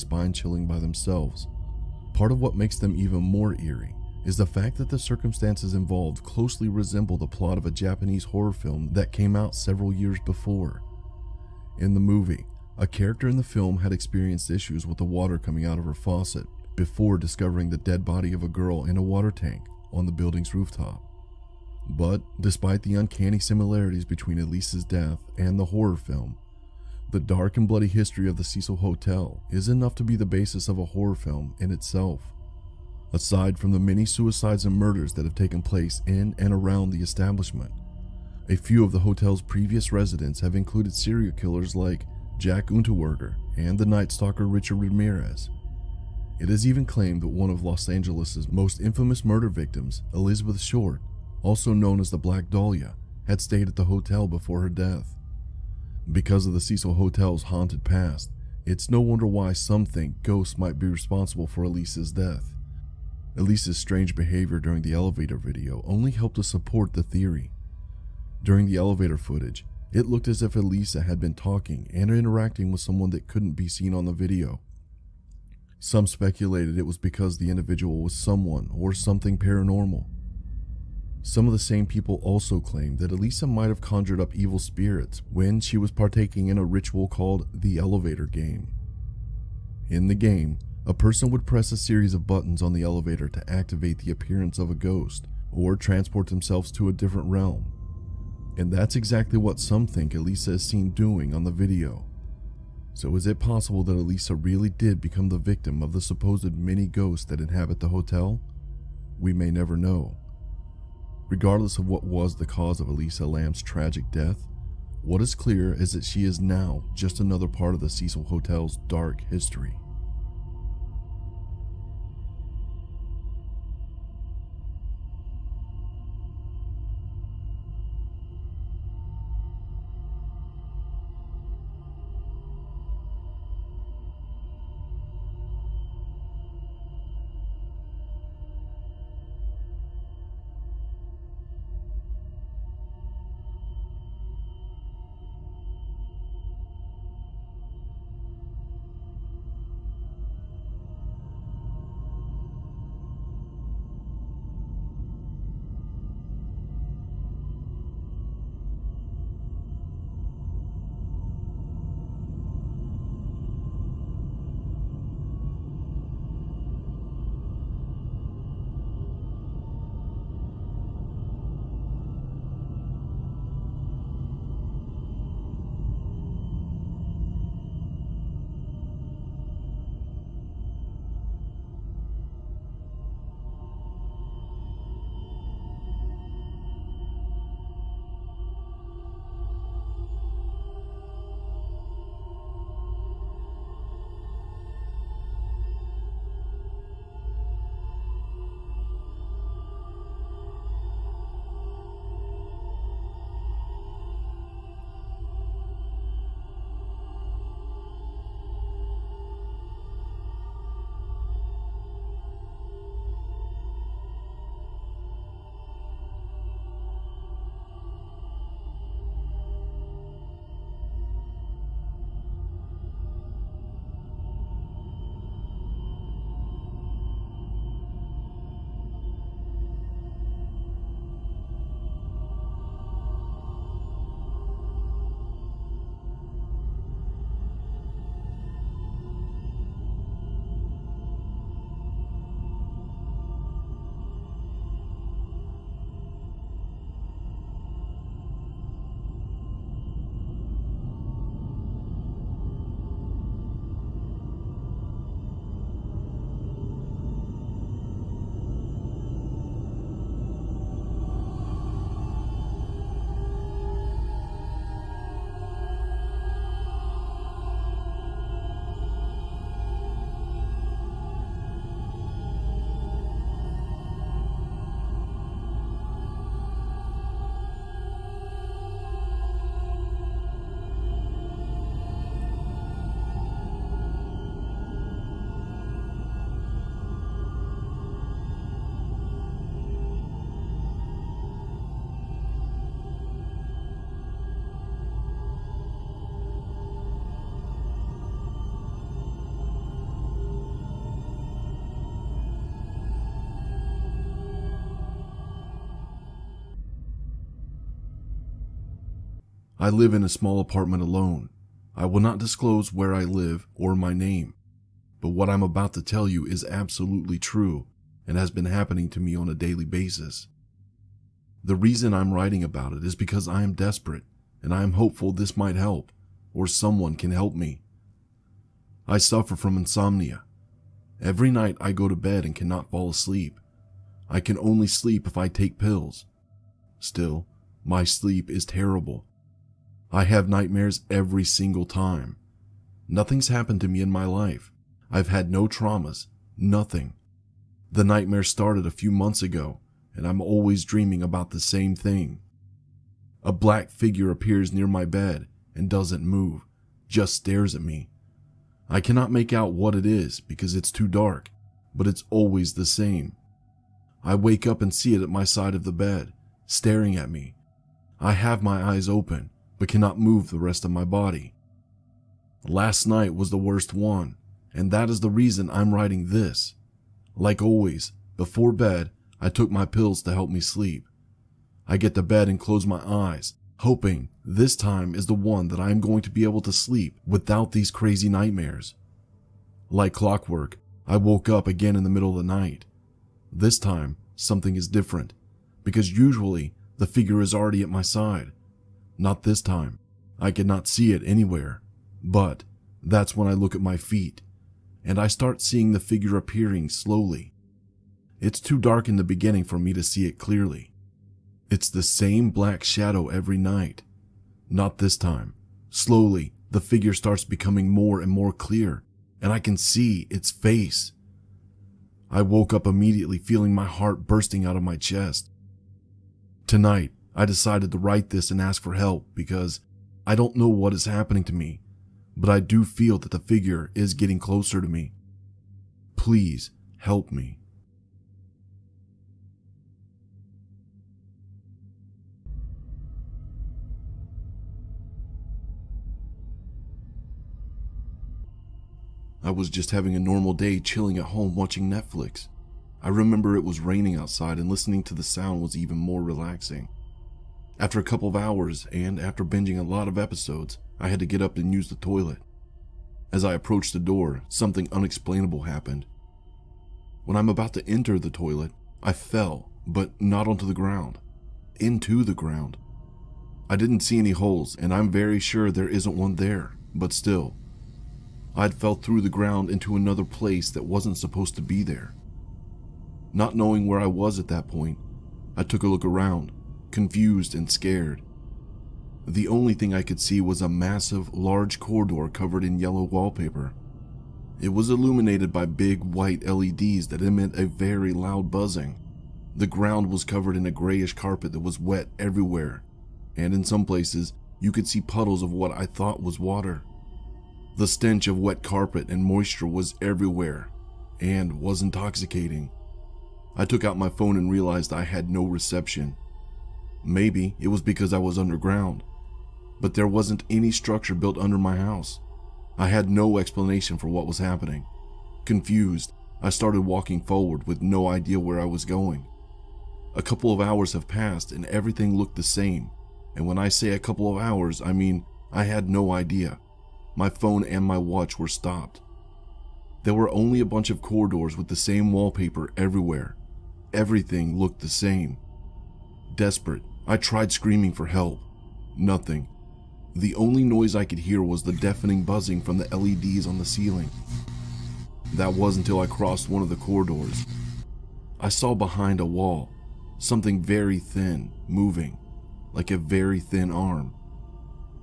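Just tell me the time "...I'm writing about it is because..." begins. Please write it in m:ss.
5:21.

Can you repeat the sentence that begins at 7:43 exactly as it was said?
As I approached the door, something unexplainable happened.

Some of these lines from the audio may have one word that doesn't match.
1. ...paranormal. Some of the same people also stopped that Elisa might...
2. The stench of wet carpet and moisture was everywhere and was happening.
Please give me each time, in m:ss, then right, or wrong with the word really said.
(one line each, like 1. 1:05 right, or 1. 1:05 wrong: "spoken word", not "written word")
1. 1:19 wrong: "claimed", not "stopped"
2. 8:27 wrong: "intoxicating", not "happening".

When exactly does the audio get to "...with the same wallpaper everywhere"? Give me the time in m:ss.
9:01.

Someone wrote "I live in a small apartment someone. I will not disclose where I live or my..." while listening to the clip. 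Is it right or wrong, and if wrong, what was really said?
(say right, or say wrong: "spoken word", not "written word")
wrong: "alone", not "someone".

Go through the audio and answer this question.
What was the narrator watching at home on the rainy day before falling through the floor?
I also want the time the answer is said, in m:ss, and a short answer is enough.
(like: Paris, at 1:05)
Netflix, at 7:31.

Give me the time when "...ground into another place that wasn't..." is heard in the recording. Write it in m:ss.
7:59.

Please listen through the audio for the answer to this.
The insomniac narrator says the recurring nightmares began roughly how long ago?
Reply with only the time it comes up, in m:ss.
5:48.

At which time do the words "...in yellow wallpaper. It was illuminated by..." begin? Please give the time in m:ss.
8:12.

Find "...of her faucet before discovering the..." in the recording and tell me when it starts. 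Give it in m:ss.
0:15.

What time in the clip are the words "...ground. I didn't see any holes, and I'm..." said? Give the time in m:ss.
7:52.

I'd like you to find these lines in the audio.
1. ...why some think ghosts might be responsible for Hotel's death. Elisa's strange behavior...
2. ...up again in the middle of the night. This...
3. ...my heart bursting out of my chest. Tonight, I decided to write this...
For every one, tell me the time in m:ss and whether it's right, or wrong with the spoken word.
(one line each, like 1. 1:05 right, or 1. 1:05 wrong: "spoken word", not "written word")
1. 0:59 wrong: "Elisa", not "Hotel"
2. 6:31 right
3. 7:03 right.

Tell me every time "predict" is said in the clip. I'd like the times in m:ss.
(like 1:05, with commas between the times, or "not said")
not said.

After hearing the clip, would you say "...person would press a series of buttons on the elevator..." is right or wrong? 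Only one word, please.
right.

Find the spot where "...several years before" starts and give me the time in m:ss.
0:09.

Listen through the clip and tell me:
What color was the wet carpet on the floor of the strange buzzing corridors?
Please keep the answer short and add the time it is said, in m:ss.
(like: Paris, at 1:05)
grayish, at 8:20.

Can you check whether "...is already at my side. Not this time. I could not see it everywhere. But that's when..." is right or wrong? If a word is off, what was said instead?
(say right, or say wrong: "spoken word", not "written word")
wrong: "anywhere", not "everywhere".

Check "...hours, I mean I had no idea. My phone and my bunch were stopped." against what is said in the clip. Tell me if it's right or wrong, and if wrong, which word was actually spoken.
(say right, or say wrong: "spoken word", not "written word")
wrong: "watch", not "bunch".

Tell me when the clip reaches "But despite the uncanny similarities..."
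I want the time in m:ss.
0:21.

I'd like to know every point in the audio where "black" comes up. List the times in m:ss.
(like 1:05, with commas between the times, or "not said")
0:52, 5:53, 6:52.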